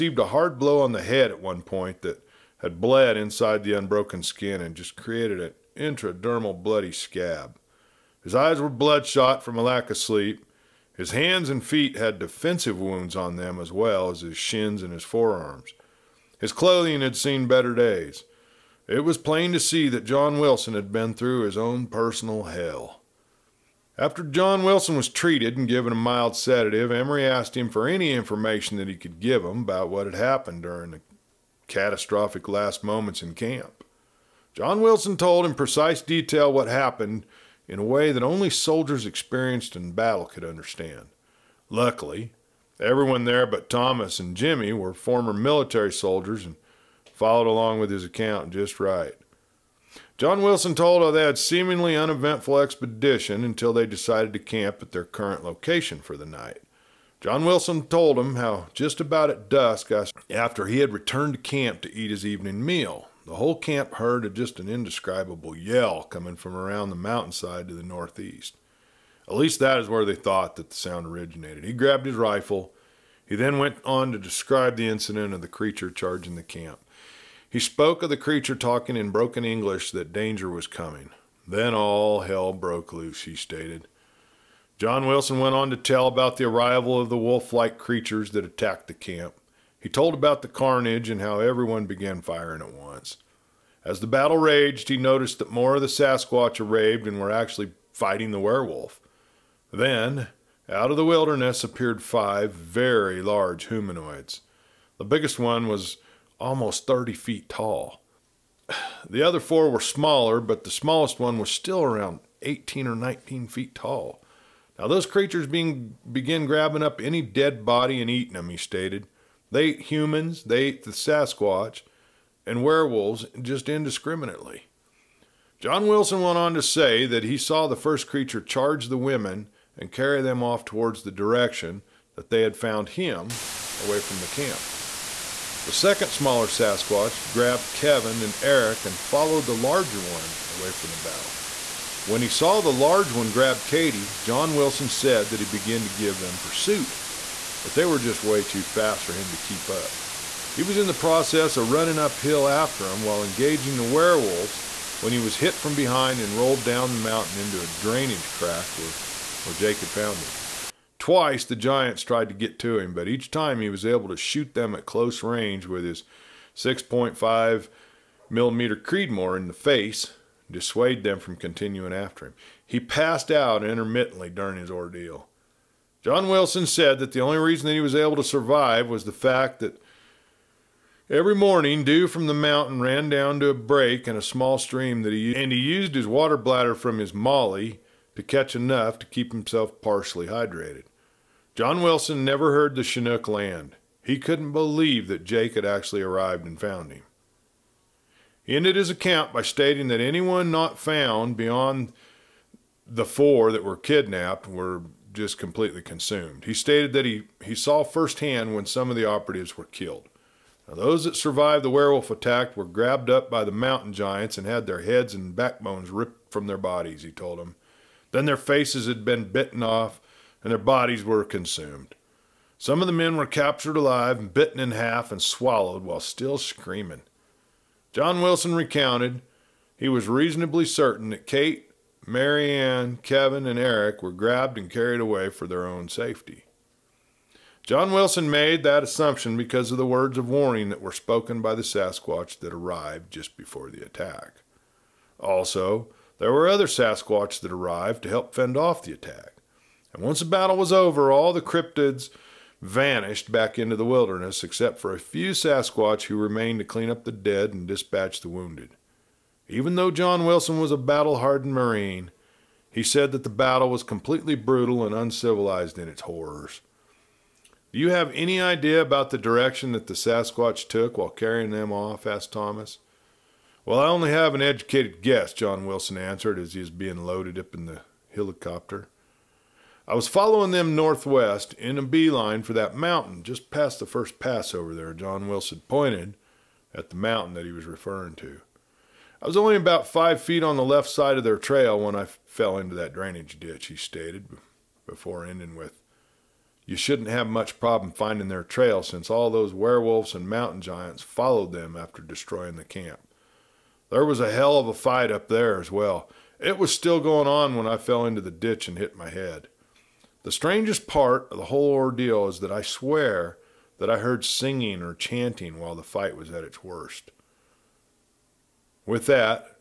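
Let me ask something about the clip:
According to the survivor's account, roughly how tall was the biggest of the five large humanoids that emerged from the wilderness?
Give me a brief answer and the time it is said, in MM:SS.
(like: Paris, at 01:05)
30 feet, at 01:46.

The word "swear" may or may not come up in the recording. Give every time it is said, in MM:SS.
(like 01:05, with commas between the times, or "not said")
05:12.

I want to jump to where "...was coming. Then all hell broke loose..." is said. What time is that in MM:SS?
01:20.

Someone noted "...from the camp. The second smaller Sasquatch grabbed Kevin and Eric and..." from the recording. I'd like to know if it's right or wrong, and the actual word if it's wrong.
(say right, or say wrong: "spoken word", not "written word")
right.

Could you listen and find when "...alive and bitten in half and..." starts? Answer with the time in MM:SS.
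03:43.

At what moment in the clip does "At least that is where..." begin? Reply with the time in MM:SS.
01:09.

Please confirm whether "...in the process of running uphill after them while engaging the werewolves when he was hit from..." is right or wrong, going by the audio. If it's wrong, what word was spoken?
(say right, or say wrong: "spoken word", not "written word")
right.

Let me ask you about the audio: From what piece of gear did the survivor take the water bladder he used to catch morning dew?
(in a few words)
MOLLE.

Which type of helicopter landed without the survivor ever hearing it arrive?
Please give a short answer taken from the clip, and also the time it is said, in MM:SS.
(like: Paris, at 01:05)
Chinook, at 03:12.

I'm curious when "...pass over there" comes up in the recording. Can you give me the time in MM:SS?
04:44.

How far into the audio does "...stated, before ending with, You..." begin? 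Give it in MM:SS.
04:53.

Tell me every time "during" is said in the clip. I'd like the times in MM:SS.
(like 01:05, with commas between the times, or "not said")
00:30, 02:54.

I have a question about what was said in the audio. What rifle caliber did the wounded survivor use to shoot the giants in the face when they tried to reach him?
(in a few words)
6.5 millimeter Creedmoor.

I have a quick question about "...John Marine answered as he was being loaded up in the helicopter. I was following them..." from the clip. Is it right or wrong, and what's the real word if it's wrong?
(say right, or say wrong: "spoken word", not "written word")
wrong: "Wilson", not "Marine".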